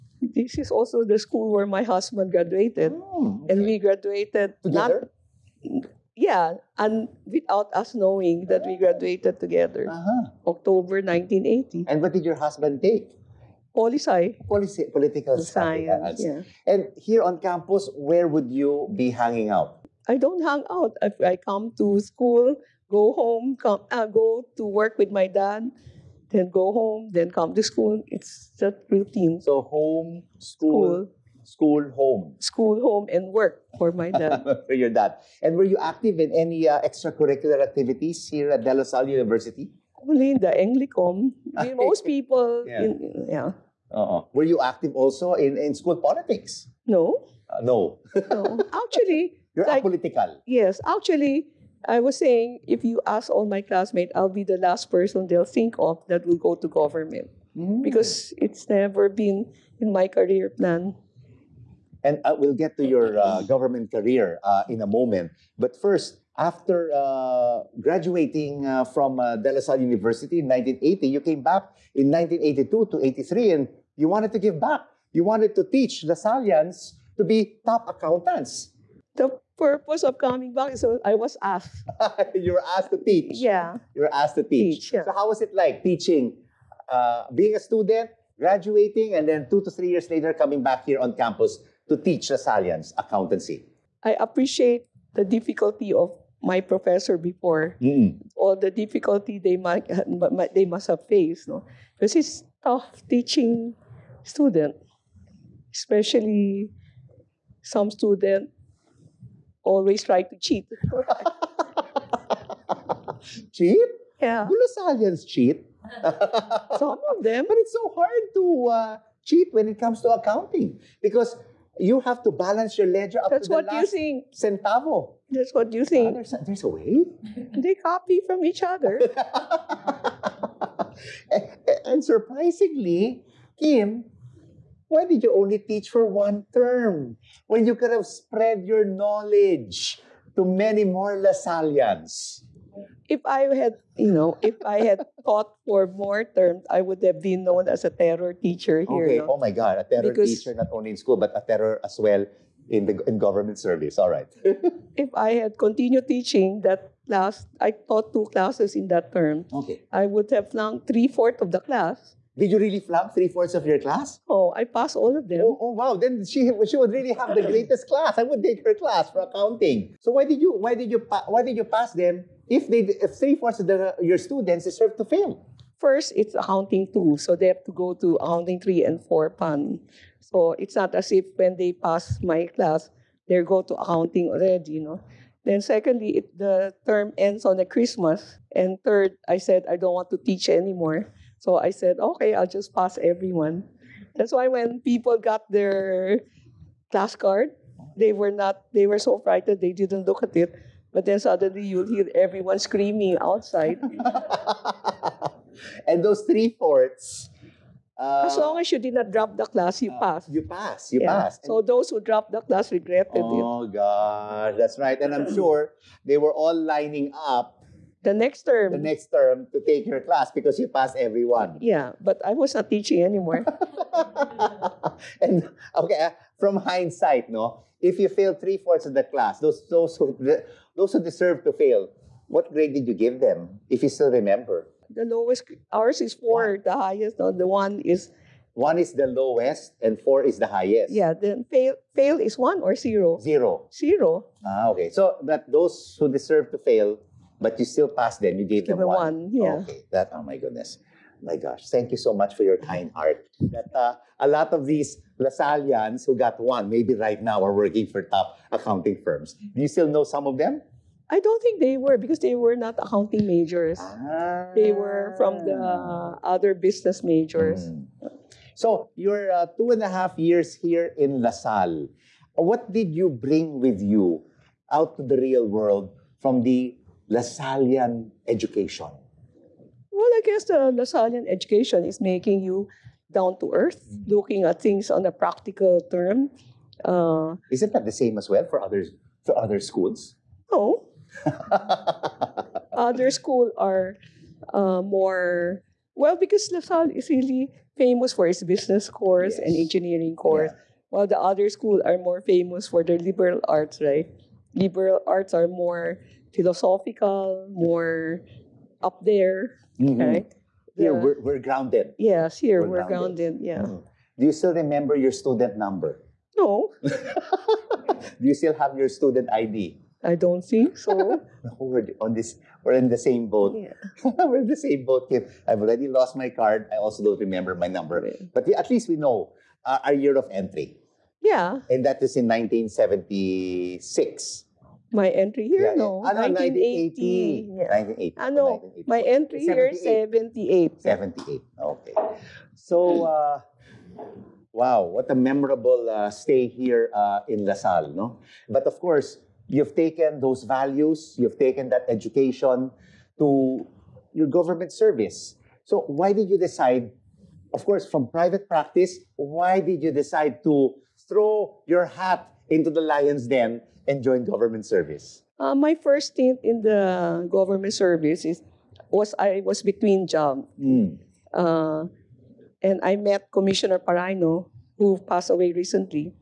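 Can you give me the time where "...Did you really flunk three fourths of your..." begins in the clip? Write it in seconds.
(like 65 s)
162 s.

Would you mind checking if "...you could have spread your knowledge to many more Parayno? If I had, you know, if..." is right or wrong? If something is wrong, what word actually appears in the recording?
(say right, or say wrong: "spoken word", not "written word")
wrong: "Lasallians", not "Parayno".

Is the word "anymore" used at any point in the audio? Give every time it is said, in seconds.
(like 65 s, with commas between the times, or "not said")
190 s, 223 s.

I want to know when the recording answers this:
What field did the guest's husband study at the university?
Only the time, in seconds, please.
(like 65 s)
14 s.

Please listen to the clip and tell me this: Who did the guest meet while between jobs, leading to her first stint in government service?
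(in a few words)
Commissioner Parayno.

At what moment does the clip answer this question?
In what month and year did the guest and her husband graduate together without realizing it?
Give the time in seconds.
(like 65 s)
10 s.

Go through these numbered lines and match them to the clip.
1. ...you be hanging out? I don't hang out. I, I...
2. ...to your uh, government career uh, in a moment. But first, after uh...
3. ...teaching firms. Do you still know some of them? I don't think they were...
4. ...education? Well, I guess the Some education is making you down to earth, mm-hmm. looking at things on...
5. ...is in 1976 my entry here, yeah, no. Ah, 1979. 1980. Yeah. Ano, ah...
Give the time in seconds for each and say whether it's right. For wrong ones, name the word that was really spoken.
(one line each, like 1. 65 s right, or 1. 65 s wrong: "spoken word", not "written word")
1. 18 s right
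2. 62 s right
3. 258 s wrong: "accounting", not "teaching"
4. 278 s wrong: "Lasallian", not "Some"
5. 332 s wrong: "1980", not "1979".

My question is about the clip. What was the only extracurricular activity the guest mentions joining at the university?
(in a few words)
Anglicom.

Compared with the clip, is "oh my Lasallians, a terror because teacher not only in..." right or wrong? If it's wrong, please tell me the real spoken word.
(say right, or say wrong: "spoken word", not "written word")
wrong: "God", not "Lasallians".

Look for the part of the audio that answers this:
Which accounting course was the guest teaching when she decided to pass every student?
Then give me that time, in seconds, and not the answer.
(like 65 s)
176 s.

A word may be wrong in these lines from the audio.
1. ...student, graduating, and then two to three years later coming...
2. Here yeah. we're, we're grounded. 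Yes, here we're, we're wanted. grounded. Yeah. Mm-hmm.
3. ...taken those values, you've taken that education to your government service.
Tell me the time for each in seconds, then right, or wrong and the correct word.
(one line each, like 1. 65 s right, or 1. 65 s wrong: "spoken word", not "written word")
1. 87 s right
2. 310 s wrong: "grounded", not "wanted"
3. 349 s right.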